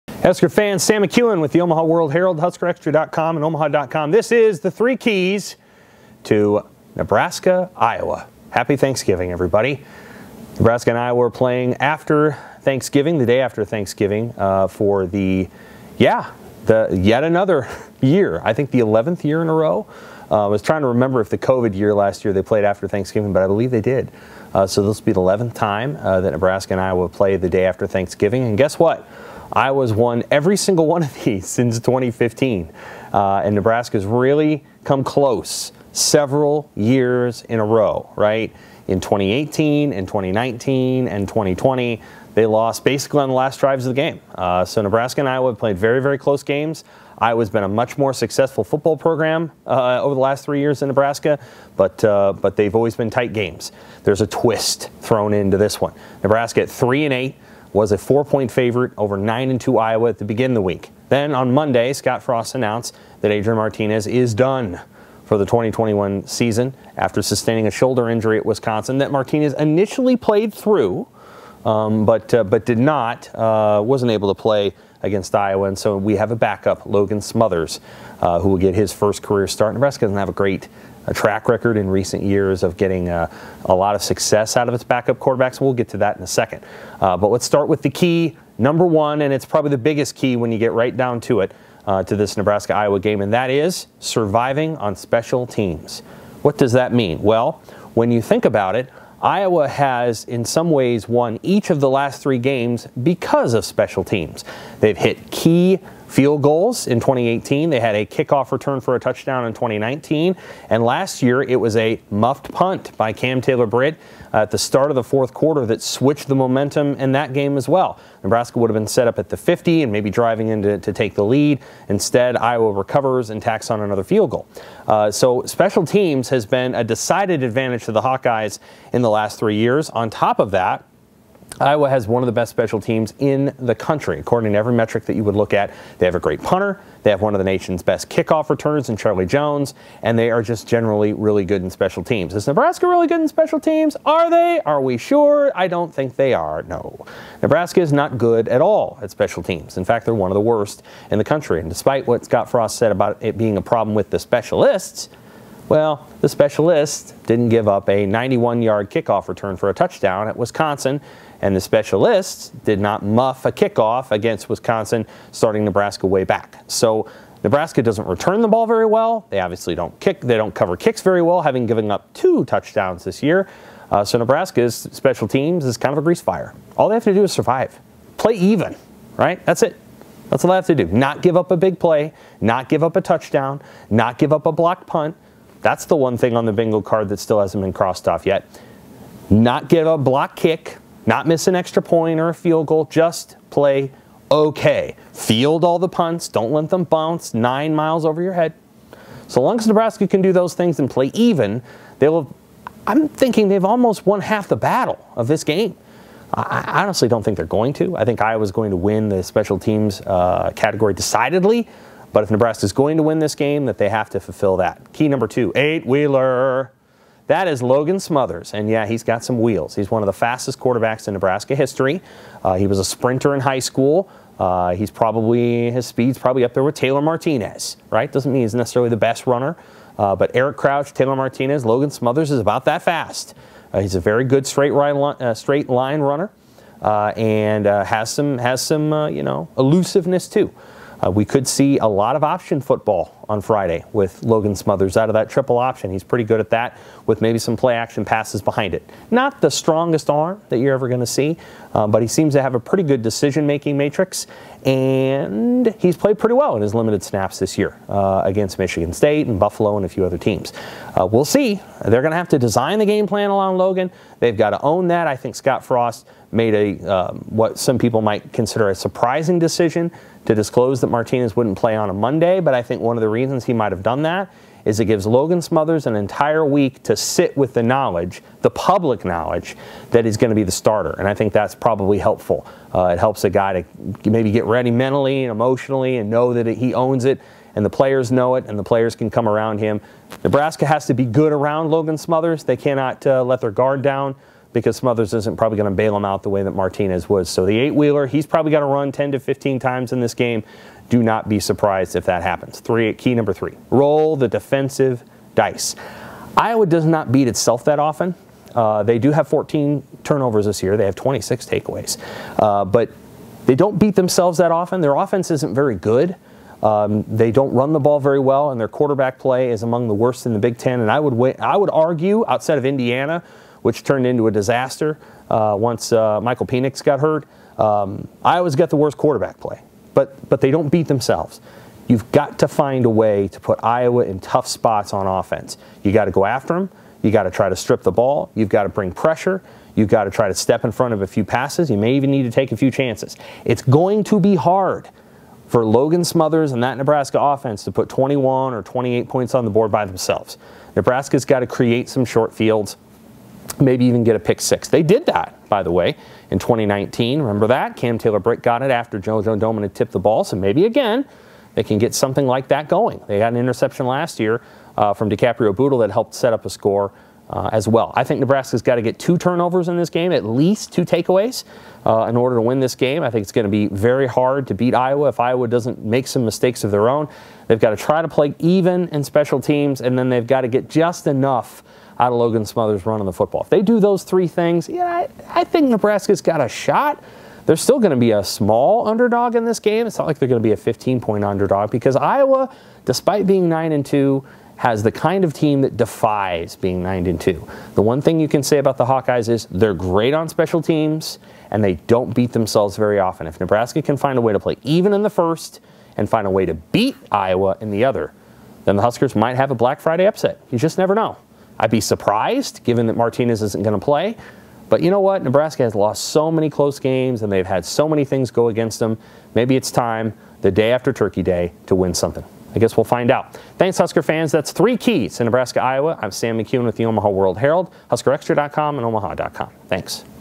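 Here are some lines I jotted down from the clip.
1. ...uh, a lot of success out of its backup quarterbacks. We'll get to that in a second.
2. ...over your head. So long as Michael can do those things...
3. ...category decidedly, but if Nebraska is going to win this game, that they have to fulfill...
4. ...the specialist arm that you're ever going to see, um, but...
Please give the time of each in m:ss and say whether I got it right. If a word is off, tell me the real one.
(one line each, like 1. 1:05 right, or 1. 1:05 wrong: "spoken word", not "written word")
1. 1:23 right
2. 3:18 wrong: "Nebraska", not "Michael"
3. 3:30 right
4. 4:09 wrong: "strongest", not "specialist".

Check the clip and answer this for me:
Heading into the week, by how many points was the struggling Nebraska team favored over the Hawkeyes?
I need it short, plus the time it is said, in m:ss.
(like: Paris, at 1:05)
4, at 0:57.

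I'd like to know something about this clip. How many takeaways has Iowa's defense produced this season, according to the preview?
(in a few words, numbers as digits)
26.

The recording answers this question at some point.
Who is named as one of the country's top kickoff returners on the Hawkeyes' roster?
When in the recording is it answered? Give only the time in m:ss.
2:18.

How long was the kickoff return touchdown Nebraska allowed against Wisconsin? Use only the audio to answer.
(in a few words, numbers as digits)
91 yards.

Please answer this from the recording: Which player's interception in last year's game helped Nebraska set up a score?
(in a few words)
DiCaprio Bootle.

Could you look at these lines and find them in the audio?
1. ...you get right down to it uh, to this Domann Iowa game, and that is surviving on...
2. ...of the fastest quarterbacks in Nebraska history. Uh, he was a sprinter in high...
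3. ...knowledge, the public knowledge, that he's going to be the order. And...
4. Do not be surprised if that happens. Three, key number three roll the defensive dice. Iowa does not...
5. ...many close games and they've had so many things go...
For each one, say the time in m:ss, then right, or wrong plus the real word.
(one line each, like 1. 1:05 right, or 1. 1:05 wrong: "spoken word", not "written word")
1. 1:30 wrong: "Nebraska", not "Domann"
2. 3:40 right
3. 4:37 wrong: "starter", not "order"
4. 5:00 right
5. 6:56 right.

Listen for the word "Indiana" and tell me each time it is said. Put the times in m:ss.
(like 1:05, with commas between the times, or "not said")
5:22.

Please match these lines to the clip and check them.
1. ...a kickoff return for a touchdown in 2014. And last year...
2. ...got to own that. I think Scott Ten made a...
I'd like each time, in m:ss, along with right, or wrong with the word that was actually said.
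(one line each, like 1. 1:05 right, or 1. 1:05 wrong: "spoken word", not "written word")
1. 1:47 wrong: "2019", not "2014"
2. 4:24 wrong: "Frost", not "Ten".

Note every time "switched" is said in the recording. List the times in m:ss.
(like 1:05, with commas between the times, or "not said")
1:55.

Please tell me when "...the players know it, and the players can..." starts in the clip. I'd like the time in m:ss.
4:47.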